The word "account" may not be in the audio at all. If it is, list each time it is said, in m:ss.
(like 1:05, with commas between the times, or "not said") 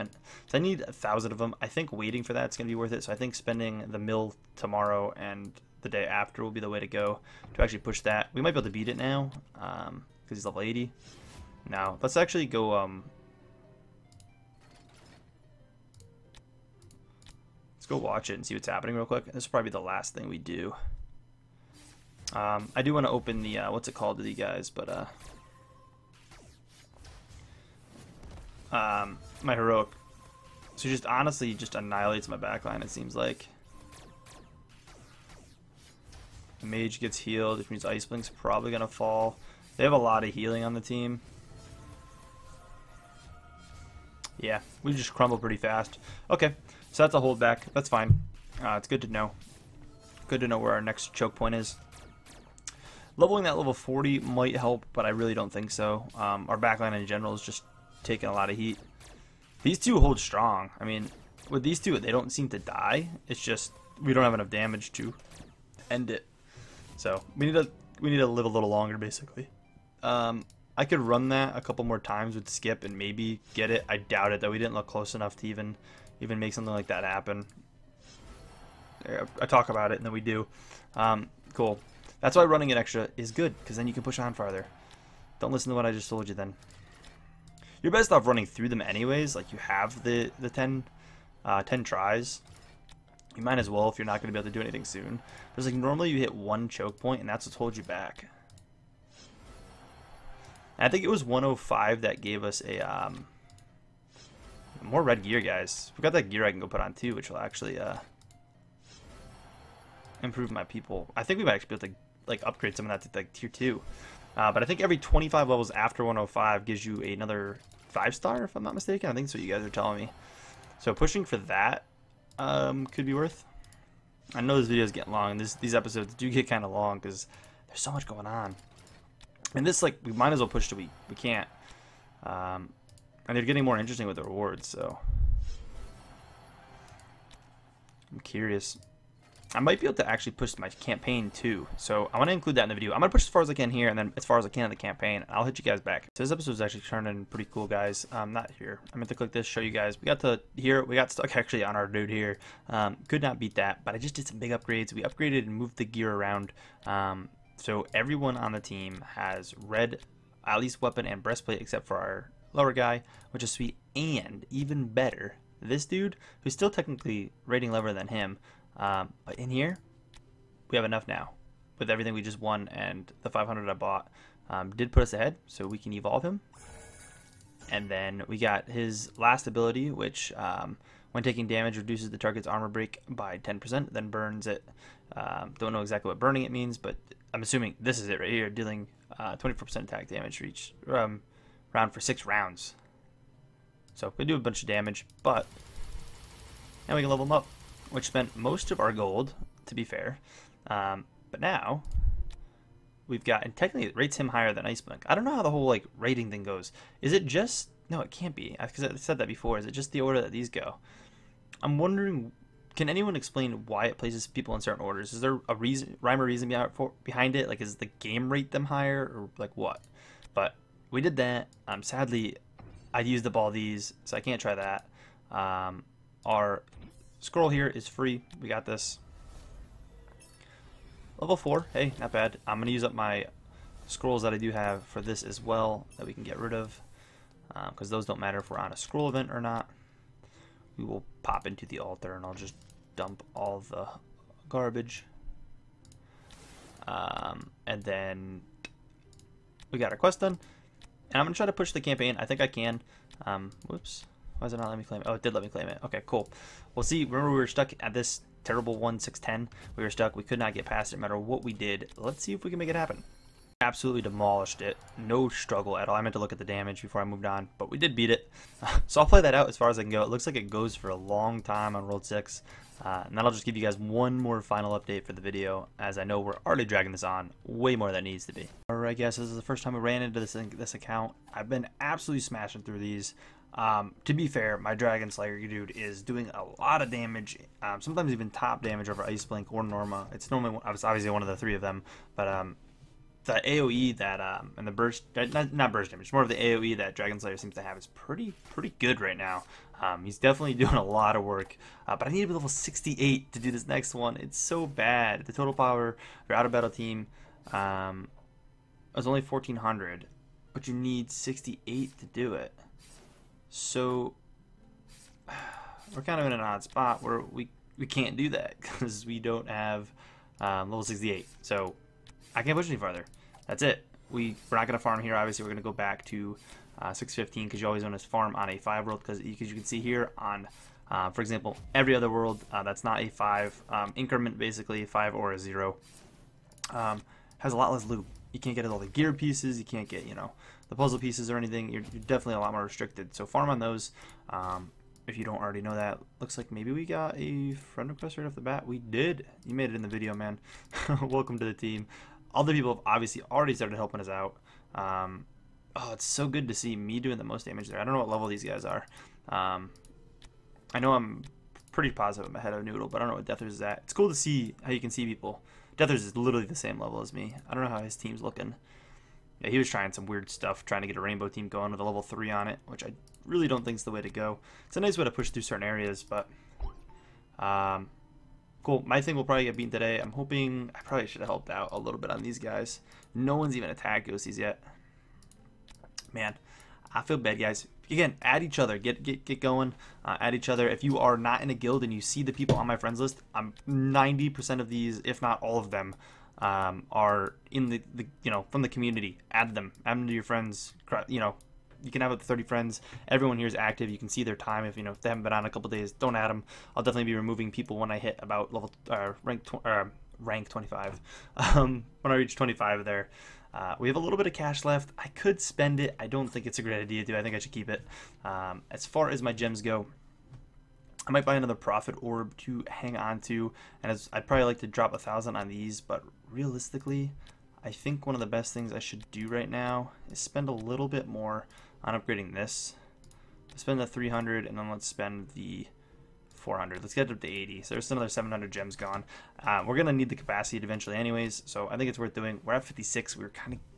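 4:40.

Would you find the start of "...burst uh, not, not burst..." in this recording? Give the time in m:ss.
4:54.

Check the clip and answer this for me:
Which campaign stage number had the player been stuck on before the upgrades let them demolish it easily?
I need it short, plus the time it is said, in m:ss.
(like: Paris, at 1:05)
1610, at 4:18.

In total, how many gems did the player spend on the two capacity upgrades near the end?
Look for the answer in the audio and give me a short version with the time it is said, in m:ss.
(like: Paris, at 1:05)
700, at 7:18.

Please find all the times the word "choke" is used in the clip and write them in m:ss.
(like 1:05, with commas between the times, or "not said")
0:51, 1:36.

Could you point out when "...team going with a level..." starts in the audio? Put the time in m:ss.
6:11.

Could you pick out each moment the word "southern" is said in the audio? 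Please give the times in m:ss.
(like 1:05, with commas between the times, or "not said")
not said.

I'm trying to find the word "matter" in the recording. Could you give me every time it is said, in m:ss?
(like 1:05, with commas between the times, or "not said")
3:58, 4:21.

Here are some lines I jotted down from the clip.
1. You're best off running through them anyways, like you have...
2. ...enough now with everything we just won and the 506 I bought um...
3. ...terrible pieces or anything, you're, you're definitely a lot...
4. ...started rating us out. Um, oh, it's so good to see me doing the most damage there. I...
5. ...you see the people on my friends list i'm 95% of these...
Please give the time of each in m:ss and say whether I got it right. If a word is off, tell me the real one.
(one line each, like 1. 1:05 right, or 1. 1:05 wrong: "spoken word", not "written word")
1. 1:27 right
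2. 2:50 wrong: "500", not "506"
3. 5:40 wrong: "puzzle", not "terrible"
4. 5:53 wrong: "helping", not "rating"
5. 6:31 wrong: "90", not "95".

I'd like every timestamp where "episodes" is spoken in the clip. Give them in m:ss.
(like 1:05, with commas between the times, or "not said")
2:05, 2:26.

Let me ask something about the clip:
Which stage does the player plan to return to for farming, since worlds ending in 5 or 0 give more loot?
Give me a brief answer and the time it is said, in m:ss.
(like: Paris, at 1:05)
615, at 5:26.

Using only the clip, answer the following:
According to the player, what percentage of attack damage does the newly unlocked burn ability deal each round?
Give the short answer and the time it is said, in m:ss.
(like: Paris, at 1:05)
24%, at 3:09.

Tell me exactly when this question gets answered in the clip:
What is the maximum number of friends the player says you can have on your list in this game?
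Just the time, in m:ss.
6:42.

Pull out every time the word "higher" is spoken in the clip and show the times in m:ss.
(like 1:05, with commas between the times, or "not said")
3:24, 3:38.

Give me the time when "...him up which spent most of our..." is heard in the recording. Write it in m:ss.
3:17.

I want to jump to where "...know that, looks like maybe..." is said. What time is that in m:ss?
5:45.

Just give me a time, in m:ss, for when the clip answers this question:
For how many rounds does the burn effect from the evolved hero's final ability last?
3:11.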